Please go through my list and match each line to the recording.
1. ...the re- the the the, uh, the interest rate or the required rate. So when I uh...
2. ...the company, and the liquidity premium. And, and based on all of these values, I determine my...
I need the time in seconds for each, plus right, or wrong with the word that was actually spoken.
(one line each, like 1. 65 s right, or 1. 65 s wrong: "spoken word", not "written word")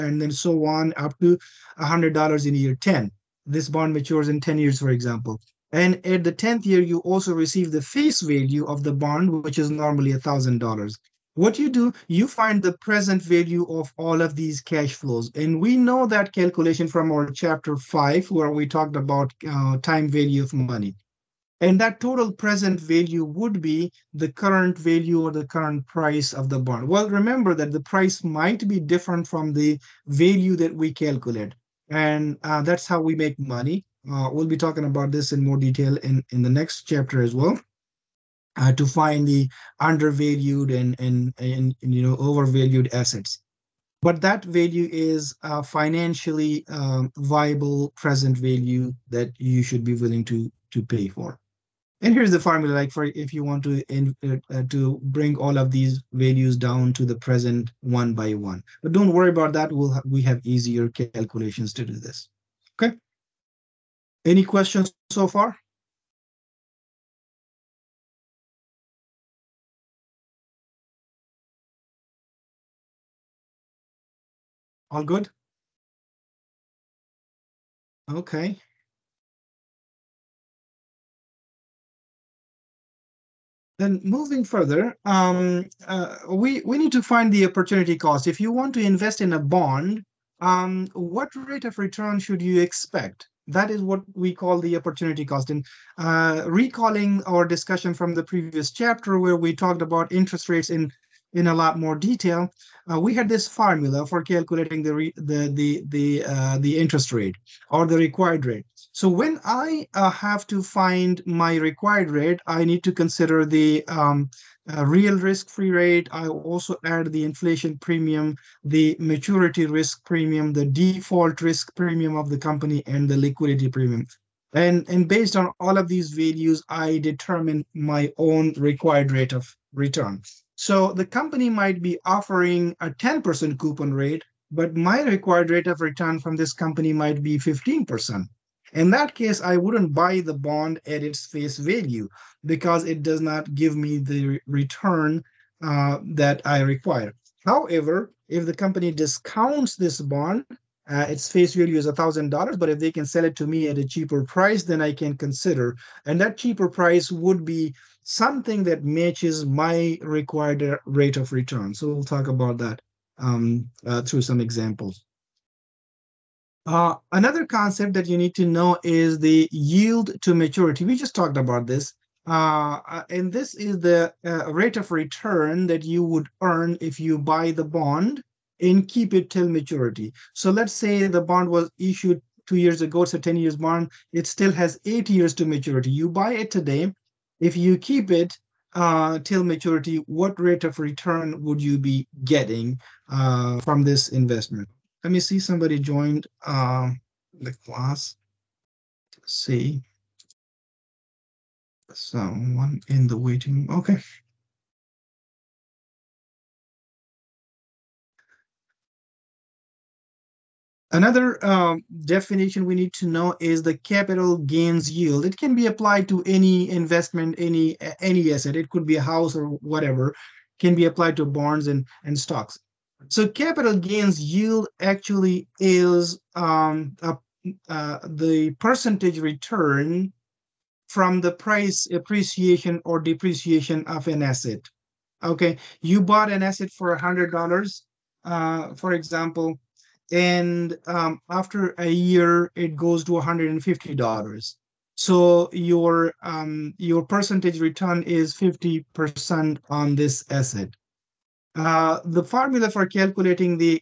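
1. 104 s right
2. 122 s right.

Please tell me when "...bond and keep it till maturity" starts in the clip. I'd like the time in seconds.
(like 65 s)
177 s.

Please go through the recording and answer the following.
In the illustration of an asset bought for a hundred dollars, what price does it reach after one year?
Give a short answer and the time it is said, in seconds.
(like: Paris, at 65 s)
$150, at 243 s.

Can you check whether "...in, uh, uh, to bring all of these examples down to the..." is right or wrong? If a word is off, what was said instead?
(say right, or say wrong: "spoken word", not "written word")
wrong: "values", not "examples".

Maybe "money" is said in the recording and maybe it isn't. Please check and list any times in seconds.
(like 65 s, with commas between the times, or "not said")
20 s, 33 s.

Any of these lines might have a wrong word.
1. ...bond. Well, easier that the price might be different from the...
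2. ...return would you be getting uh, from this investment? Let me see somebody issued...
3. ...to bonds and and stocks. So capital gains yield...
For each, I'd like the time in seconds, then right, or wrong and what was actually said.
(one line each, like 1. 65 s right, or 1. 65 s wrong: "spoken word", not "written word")
1. 26 s wrong: "remember", not "easier"
2. 190 s wrong: "joined", not "issued"
3. 221 s right.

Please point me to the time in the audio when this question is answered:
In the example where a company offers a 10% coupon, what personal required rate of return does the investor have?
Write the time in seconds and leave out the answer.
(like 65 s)
137 s.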